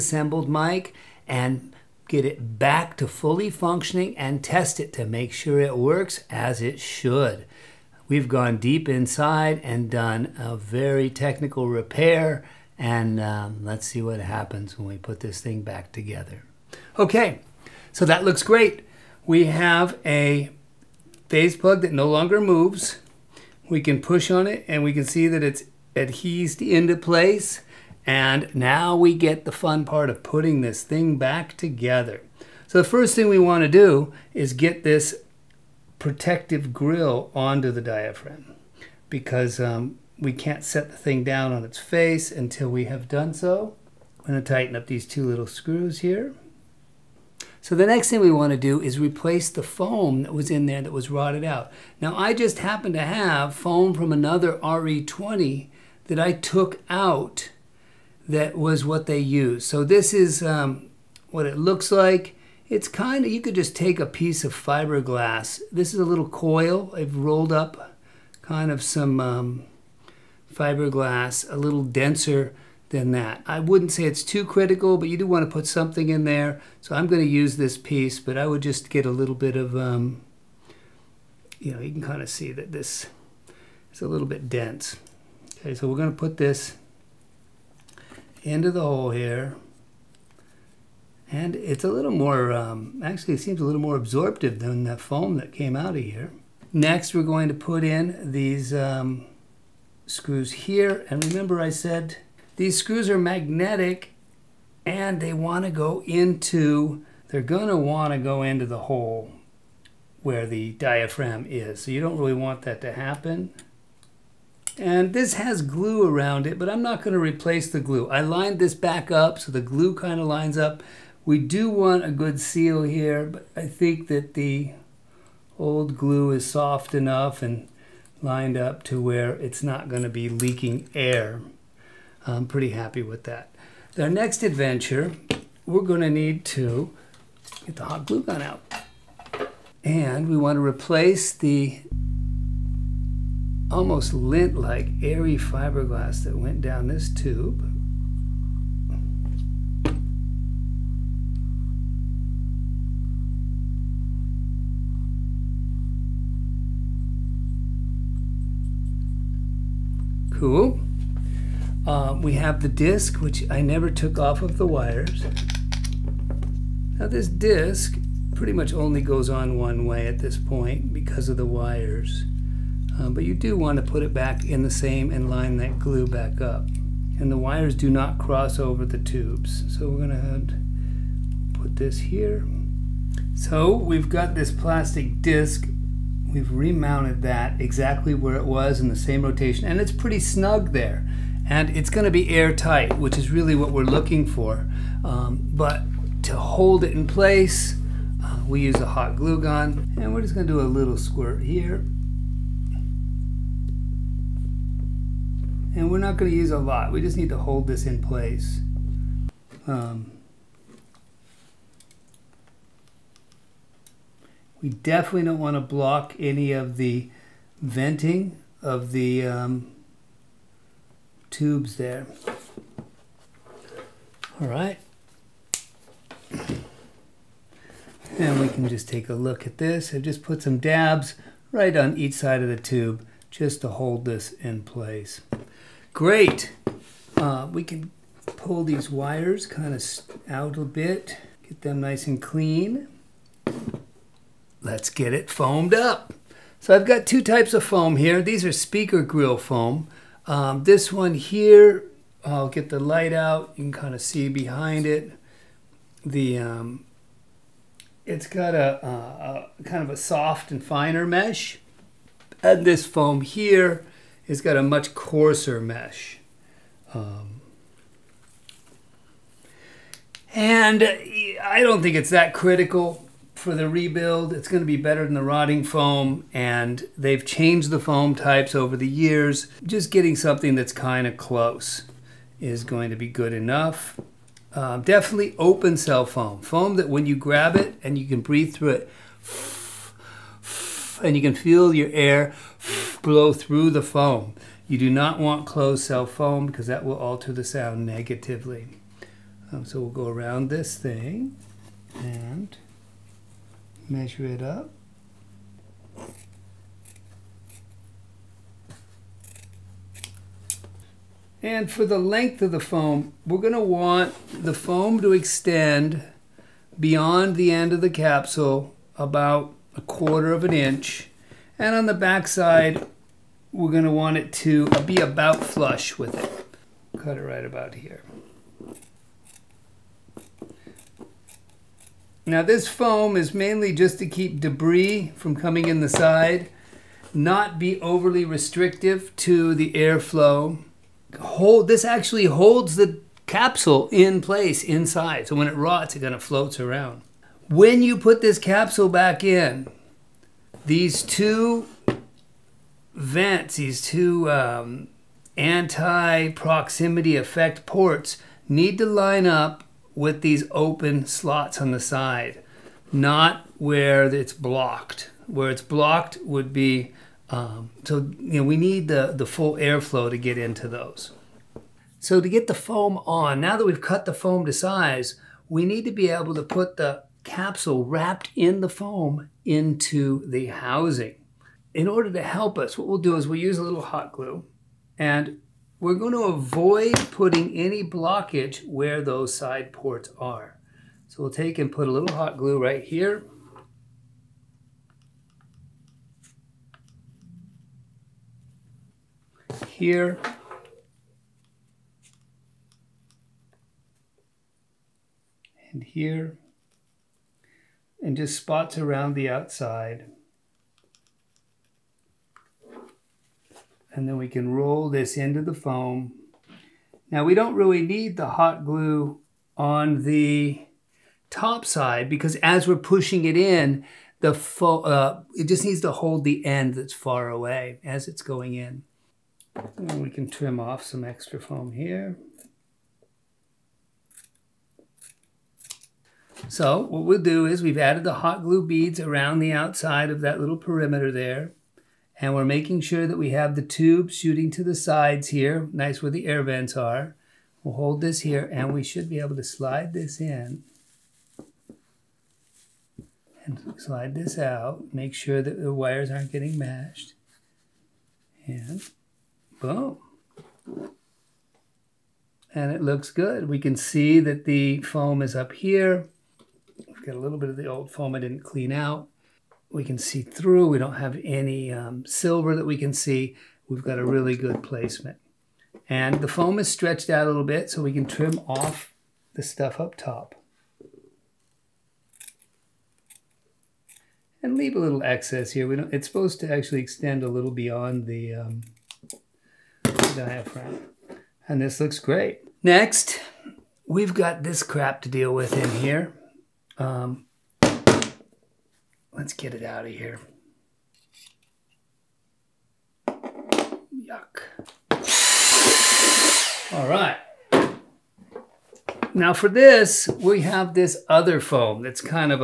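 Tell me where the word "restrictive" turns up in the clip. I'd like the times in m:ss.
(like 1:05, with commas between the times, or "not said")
5:38.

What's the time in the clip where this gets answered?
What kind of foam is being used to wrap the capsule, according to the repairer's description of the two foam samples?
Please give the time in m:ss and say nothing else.
4:08.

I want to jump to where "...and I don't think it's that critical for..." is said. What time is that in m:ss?
4:30.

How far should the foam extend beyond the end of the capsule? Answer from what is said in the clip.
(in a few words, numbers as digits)
a quarter of an inch.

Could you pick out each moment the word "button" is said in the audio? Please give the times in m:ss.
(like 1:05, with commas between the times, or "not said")
not said.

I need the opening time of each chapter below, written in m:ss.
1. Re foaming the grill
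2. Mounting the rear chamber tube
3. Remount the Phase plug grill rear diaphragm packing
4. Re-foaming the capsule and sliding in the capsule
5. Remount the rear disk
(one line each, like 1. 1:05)
1. 8:12
2. 1:36
3. 0:16
4. 4:05
5. 2:43.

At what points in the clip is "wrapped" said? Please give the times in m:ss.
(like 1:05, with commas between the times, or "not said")
6:17.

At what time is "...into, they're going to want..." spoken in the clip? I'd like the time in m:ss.
1:46.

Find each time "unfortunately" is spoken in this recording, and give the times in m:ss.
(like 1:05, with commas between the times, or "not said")
not said.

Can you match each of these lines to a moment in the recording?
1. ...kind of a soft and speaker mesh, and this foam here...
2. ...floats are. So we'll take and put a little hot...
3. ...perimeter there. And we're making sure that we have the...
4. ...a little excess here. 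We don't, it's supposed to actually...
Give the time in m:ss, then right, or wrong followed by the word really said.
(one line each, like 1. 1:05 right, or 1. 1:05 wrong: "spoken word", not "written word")
1. 4:19 wrong: "finer", not "speaker"
2. 6:29 wrong: "ports", not "floats"
3. 7:20 right
4. 8:04 right.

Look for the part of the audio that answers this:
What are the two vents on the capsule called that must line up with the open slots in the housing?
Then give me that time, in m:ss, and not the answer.
5:55.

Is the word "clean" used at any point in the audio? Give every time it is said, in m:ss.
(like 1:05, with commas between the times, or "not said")
4:02, 7:48.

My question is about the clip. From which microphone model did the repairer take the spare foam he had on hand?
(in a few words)
RE20.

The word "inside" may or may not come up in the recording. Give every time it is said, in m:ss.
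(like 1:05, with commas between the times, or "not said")
0:08, 5:44.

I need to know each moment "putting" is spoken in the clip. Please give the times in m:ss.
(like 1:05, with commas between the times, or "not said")
0:30, 6:27.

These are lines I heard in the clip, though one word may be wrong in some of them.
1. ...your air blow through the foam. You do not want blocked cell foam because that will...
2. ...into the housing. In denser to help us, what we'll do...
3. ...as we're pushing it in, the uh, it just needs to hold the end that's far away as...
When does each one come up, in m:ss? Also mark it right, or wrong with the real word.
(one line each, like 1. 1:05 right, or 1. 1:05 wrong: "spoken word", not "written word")
1. 4:51 wrong: "closed", not "blocked"
2. 6:19 wrong: "order", not "denser"
3. 7:02 right.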